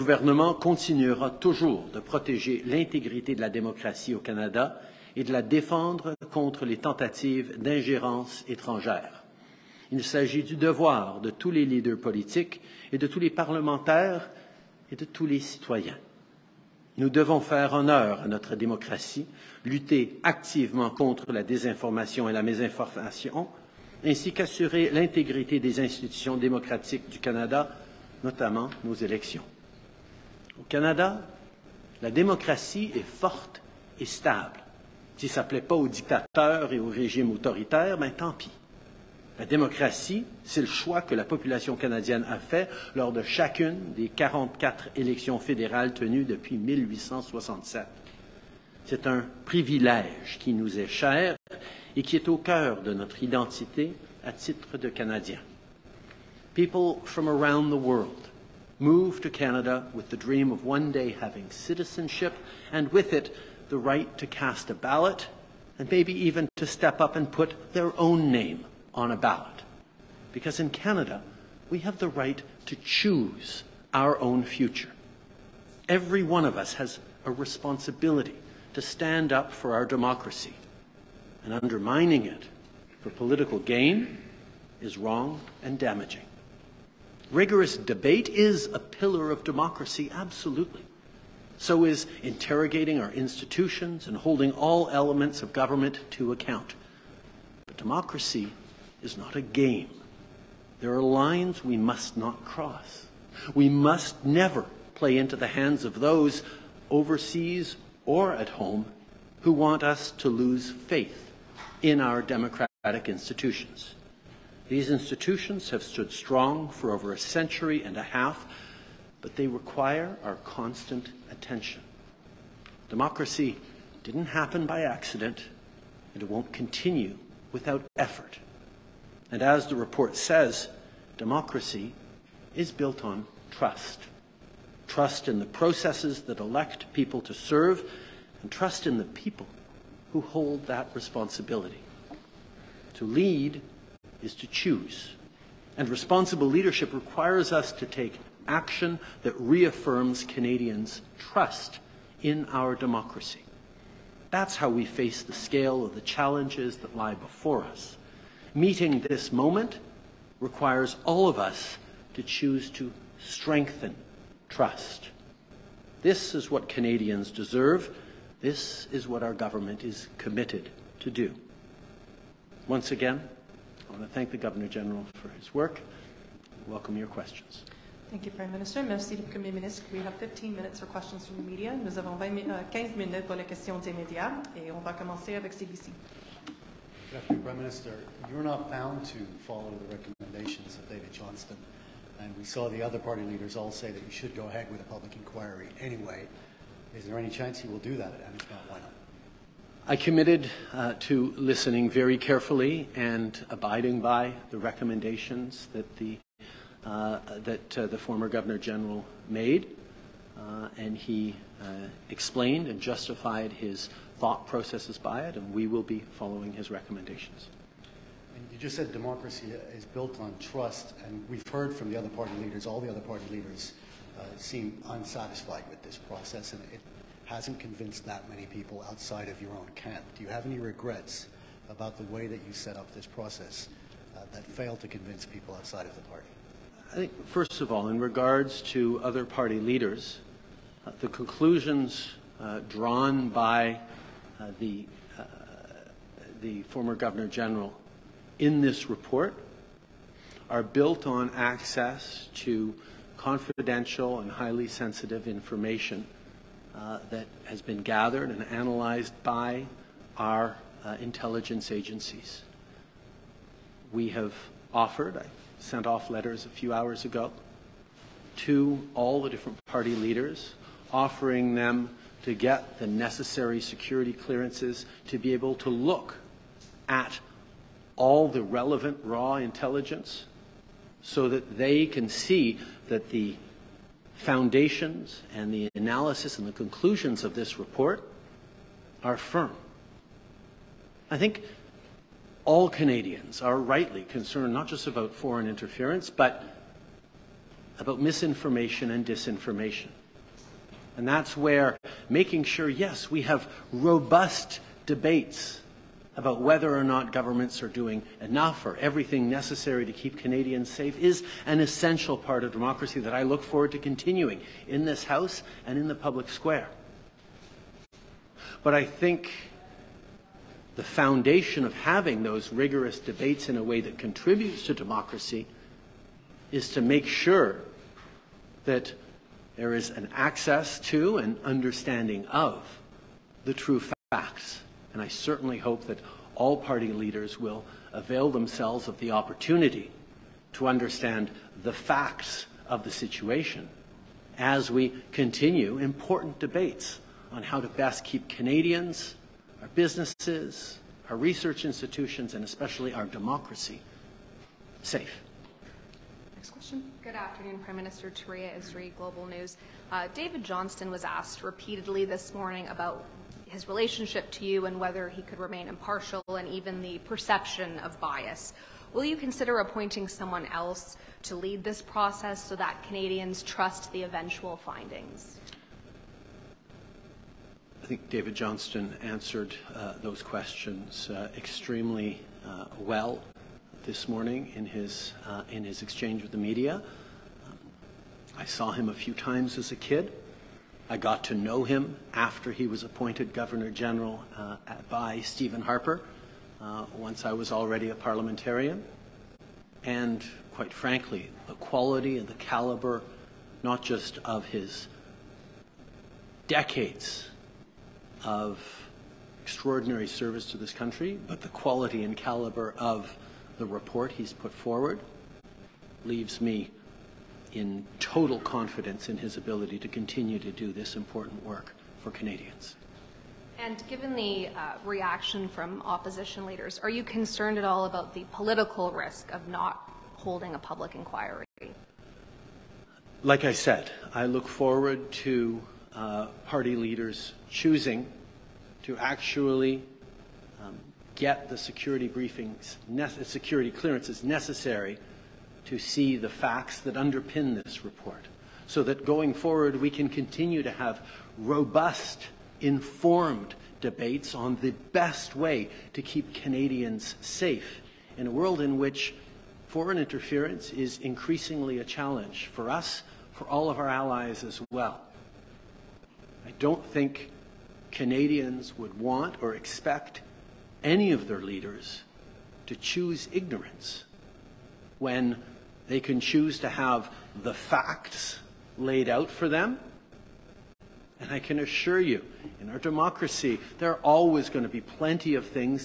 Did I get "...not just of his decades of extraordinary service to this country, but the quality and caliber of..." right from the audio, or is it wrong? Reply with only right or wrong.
right.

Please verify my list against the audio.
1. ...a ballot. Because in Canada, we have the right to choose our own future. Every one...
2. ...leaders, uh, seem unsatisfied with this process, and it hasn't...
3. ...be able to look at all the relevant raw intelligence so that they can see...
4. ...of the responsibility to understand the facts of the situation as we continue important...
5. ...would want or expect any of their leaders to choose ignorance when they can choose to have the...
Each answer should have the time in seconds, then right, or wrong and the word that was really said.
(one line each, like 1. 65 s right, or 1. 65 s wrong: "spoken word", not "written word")
1. 69 s right
2. 223 s right
3. 275 s right
4. 338 s wrong: "opportunity", not "responsibility"
5. 468 s right.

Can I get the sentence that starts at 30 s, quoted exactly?
Au Canada, la démocratie est forte et stable.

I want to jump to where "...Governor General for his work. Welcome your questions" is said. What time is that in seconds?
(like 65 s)
174 s.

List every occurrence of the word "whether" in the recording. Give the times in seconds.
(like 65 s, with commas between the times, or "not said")
306 s, 364 s.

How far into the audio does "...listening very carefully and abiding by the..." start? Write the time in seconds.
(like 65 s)
201 s.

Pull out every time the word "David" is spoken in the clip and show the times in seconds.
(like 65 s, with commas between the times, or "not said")
190 s, 360 s, 378 s.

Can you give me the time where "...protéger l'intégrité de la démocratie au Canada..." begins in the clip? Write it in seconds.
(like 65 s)
1 s.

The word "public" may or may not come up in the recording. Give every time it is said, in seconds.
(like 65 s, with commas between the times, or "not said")
194 s, 315 s, 430 s.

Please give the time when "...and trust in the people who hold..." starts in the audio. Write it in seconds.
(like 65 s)
138 s.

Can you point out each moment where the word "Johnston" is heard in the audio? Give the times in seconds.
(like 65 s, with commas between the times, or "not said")
191 s, 360 s, 378 s.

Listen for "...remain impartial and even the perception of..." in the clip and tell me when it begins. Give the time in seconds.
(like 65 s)
365 s.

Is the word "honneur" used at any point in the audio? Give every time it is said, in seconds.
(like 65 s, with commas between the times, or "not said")
17 s.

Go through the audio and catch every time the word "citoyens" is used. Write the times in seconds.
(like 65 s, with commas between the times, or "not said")
15 s.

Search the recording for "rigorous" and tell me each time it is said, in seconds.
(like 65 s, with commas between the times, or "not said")
87 s, 322 s.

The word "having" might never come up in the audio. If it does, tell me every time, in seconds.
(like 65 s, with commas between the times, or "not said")
61 s, 321 s.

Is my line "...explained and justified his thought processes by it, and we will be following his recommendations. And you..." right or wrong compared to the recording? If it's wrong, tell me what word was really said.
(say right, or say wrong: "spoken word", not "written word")
right.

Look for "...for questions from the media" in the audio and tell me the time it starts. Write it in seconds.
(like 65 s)
180 s.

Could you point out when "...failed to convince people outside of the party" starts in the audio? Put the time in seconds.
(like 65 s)
234 s.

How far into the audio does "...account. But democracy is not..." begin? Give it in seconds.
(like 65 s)
96 s.